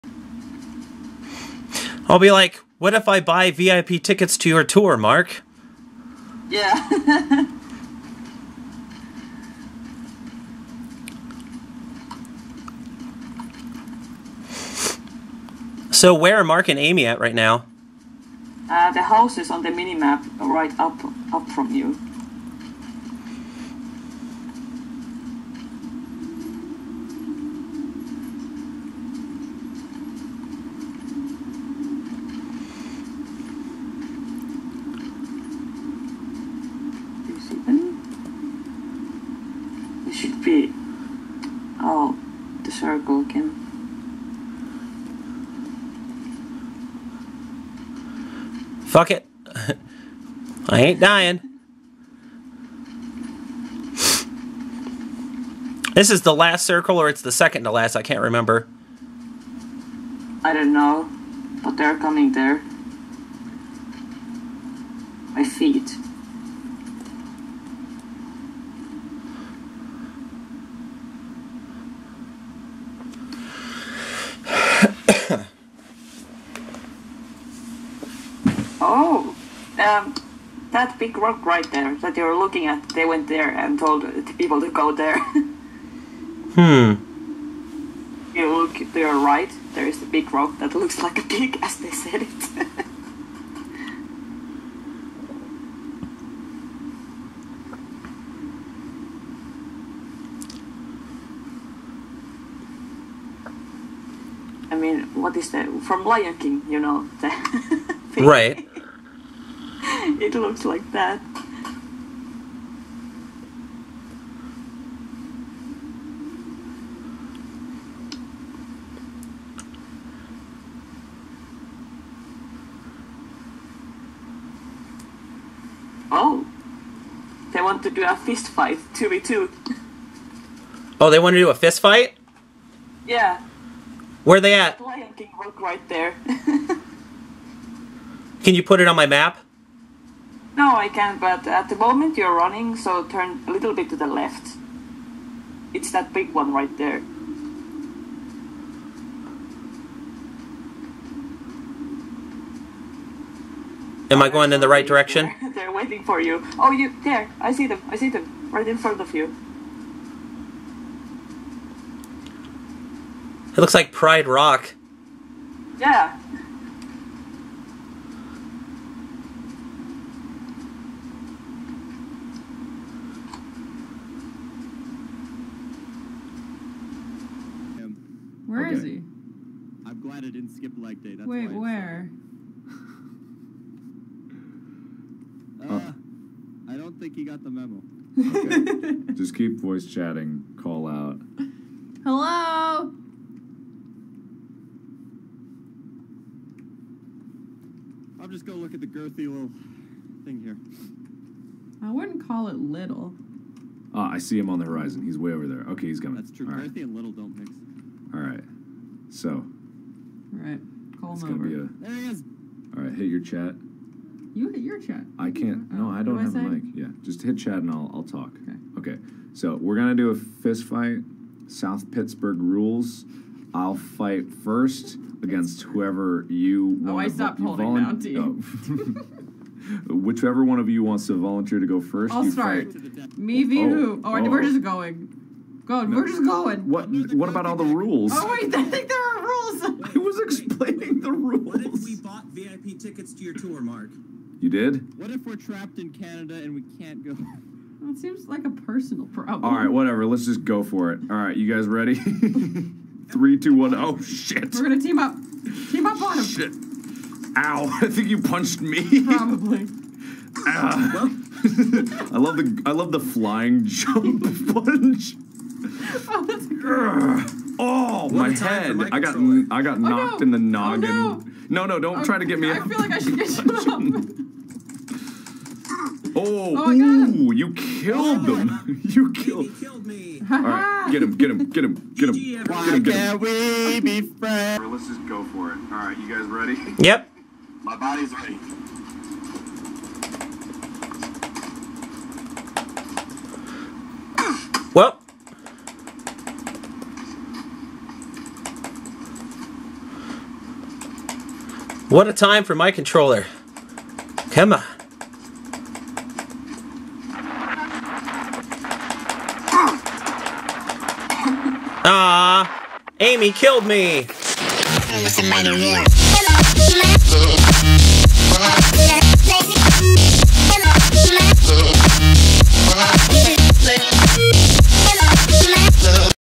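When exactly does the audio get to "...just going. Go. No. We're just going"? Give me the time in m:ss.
3:54.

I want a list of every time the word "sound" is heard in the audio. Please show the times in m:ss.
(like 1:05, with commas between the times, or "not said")
not said.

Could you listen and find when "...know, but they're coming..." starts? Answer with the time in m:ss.
1:00.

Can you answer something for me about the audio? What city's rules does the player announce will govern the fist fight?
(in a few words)
South Pittsburgh.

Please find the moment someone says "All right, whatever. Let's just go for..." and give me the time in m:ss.
4:09.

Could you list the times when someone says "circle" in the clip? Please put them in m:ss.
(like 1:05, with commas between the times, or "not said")
0:42, 0:56.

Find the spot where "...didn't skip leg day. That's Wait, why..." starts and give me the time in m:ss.
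3:00.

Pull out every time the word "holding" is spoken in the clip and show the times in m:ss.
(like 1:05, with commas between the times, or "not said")
3:47.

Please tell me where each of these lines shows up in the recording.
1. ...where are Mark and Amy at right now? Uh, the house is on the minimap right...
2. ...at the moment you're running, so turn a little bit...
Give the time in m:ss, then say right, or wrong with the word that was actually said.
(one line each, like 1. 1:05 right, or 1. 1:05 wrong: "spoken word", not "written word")
1. 0:16 right
2. 2:21 right.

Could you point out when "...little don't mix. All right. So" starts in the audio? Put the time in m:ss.
3:26.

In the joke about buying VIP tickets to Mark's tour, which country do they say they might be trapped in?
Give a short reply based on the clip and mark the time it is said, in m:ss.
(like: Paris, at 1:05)
Canada, at 4:05.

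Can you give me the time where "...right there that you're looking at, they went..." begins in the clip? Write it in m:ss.
1:21.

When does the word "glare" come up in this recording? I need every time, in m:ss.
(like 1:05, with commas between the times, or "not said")
not said.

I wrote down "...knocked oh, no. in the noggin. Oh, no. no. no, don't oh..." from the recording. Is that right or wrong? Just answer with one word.
right.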